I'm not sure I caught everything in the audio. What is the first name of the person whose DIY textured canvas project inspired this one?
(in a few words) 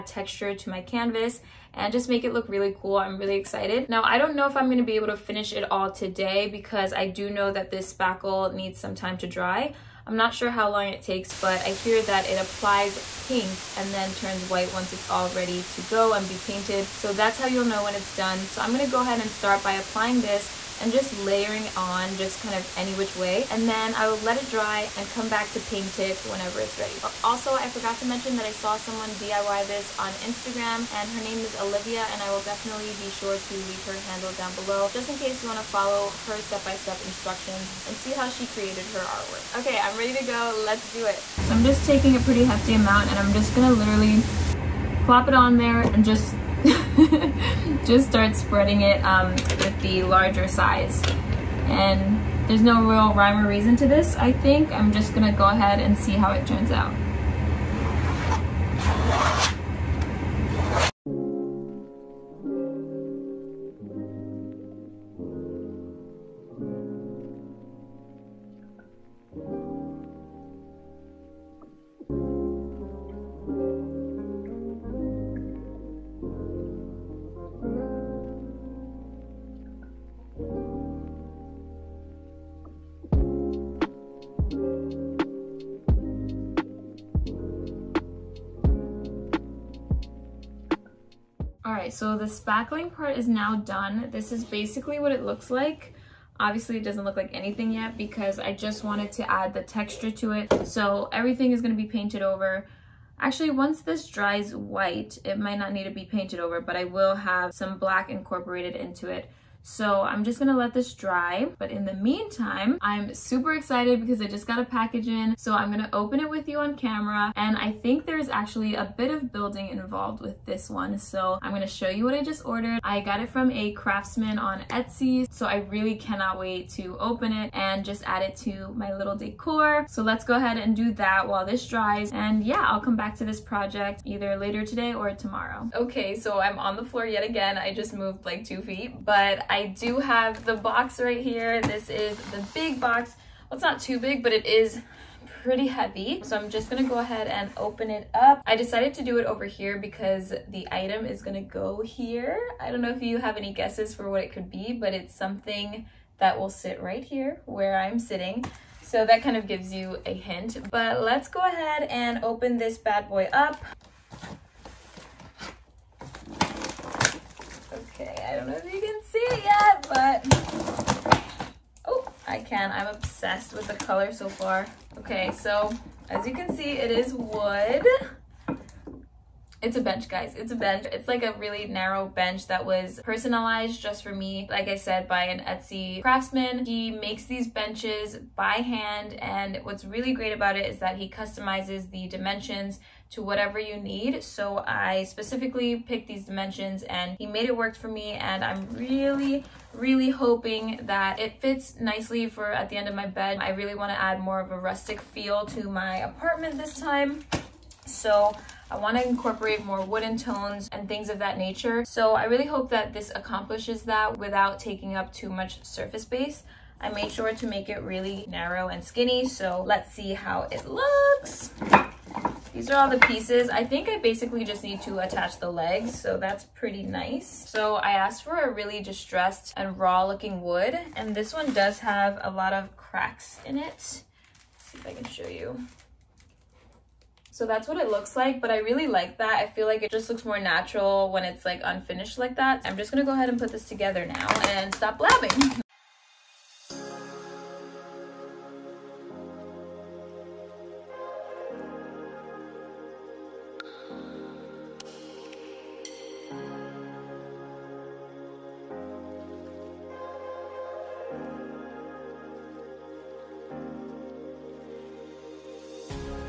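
Olivia.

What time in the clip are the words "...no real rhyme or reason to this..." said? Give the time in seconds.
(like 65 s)
52 s.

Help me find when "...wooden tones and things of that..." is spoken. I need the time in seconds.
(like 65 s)
209 s.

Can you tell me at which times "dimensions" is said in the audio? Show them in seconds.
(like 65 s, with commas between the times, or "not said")
192 s, 196 s.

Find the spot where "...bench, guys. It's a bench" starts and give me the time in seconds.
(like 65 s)
179 s.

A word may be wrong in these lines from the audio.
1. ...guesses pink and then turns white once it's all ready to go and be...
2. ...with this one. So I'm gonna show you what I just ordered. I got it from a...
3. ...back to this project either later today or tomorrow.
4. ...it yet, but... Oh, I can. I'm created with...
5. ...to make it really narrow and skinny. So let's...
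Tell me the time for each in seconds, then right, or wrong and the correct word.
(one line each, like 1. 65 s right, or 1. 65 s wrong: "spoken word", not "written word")
1. 12 s wrong: "applies", not "guesses"
2. 120 s right
3. 132 s right
4. 169 s wrong: "obsessed", not "created"
5. 217 s right.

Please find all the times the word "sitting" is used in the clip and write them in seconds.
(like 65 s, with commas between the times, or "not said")
157 s.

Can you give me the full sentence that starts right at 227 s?
So I asked for a really distressed and raw looking wood, and this one does have a lot of cracks in it.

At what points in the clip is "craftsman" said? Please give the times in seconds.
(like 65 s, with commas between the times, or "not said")
123 s, 186 s.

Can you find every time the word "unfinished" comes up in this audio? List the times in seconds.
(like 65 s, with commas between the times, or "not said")
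241 s.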